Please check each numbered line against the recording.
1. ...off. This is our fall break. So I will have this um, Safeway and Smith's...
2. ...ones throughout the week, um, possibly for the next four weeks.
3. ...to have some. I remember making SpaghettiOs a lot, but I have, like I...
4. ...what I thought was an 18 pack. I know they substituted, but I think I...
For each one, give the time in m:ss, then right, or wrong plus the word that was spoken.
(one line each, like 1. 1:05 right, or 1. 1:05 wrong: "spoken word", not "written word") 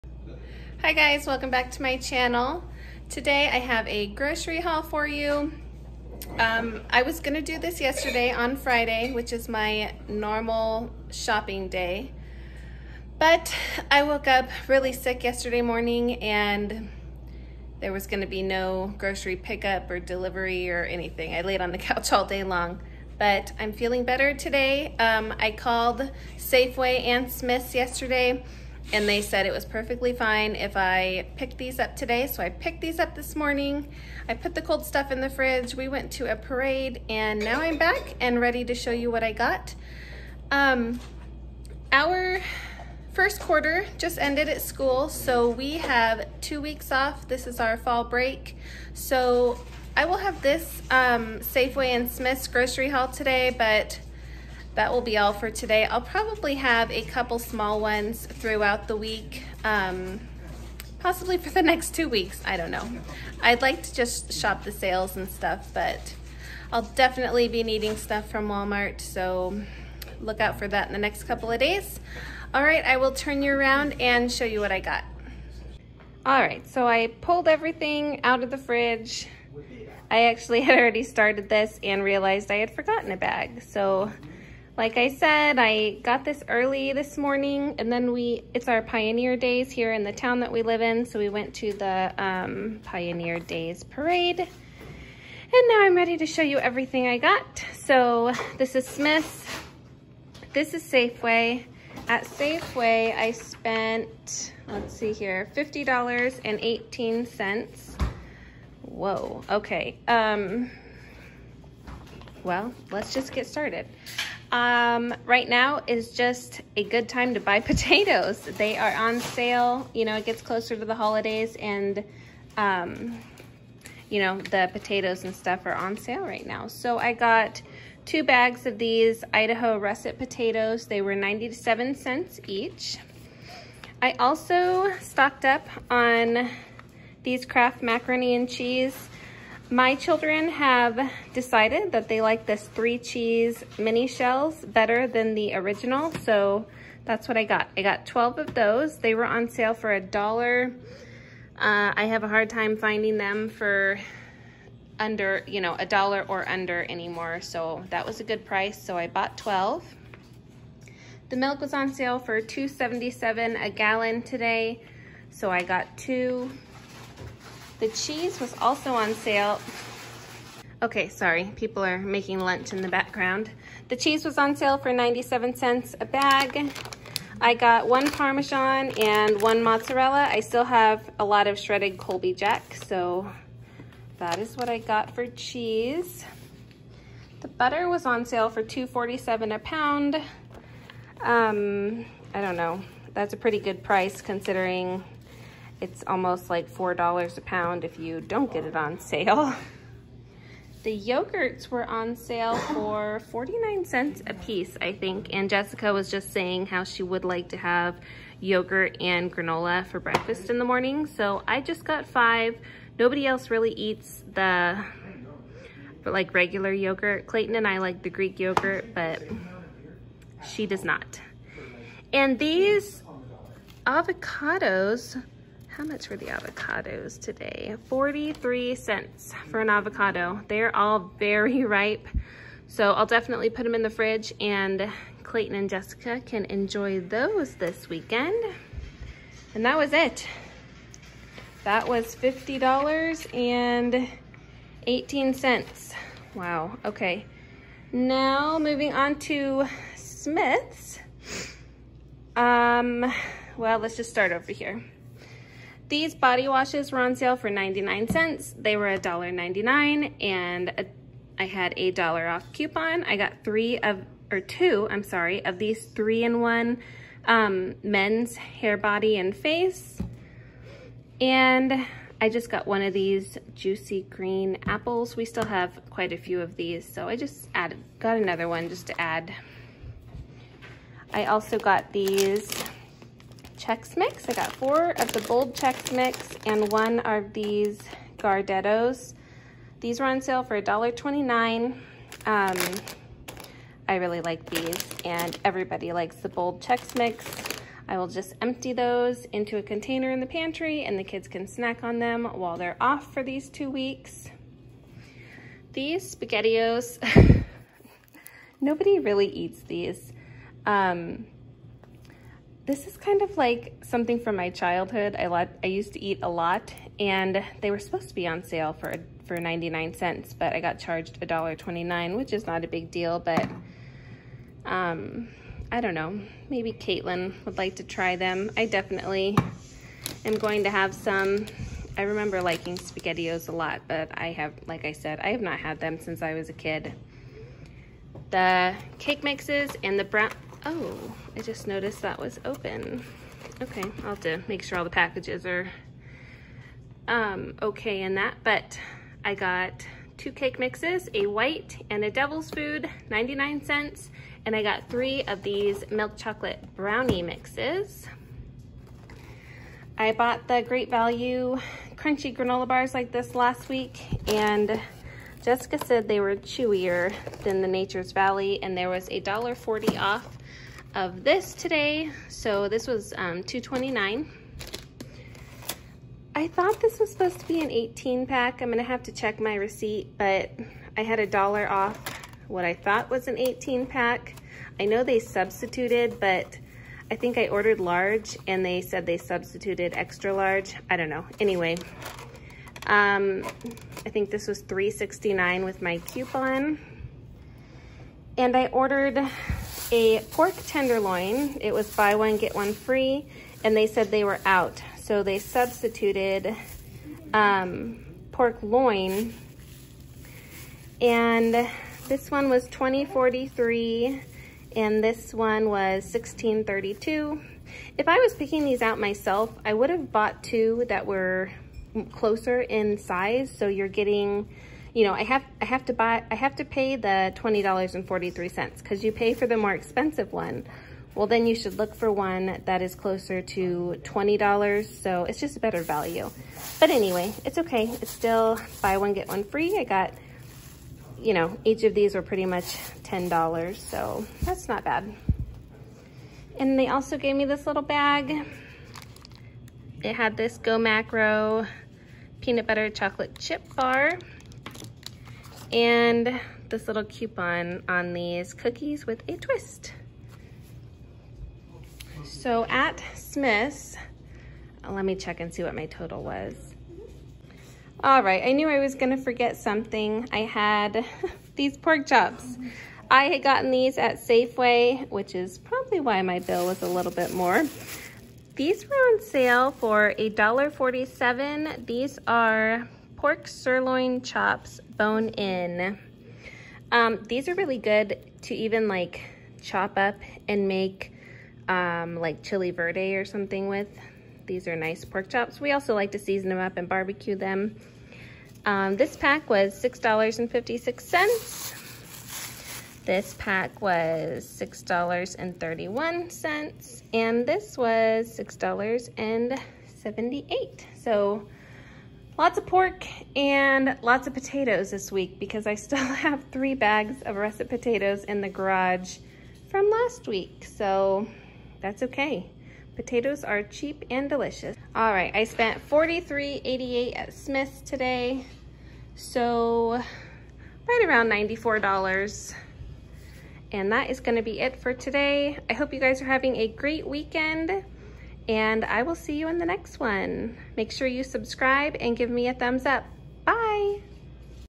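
1. 0:46 right
2. 0:57 wrong: "two", not "four"
3. 5:30 wrong: "liking", not "making"
4. 6:22 right.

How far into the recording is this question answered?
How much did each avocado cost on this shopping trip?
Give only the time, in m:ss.
3:47.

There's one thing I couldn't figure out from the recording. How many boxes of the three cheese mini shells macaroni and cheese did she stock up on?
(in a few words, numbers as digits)
12.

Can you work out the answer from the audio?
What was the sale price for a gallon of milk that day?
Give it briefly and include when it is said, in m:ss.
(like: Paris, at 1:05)
$2.77, at 2:42.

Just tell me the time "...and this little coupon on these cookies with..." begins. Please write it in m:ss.
7:35.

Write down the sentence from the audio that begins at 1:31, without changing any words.
So we went to the um, Pioneer Days parade.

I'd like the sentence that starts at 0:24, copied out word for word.
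Um, I called Safeway and Smith's yesterday and they said it was perfectly fine if I picked these up today.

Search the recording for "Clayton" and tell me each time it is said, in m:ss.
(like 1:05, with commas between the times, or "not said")
3:37, 3:55.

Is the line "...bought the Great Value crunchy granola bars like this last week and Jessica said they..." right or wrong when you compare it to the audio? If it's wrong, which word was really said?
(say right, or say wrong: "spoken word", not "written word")
right.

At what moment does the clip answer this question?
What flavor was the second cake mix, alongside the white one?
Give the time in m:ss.
5:52.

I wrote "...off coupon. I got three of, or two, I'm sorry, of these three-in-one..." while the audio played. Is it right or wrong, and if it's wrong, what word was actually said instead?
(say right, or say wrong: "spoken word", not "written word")
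right.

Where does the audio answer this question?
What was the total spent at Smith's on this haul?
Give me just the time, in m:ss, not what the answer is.
8:45.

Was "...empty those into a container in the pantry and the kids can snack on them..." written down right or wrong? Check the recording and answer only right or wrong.
right.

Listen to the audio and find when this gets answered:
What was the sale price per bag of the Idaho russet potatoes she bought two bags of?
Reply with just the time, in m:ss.
2:11.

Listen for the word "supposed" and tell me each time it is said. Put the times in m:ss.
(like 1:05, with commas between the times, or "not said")
5:17, 6:17.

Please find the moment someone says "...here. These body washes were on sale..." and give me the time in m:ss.
4:14.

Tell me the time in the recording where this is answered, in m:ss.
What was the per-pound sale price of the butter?
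3:08.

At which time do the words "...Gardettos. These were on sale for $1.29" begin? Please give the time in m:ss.
4:48.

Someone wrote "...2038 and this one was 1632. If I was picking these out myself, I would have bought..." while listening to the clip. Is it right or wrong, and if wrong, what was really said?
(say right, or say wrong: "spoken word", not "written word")
wrong: "2043", not "2038".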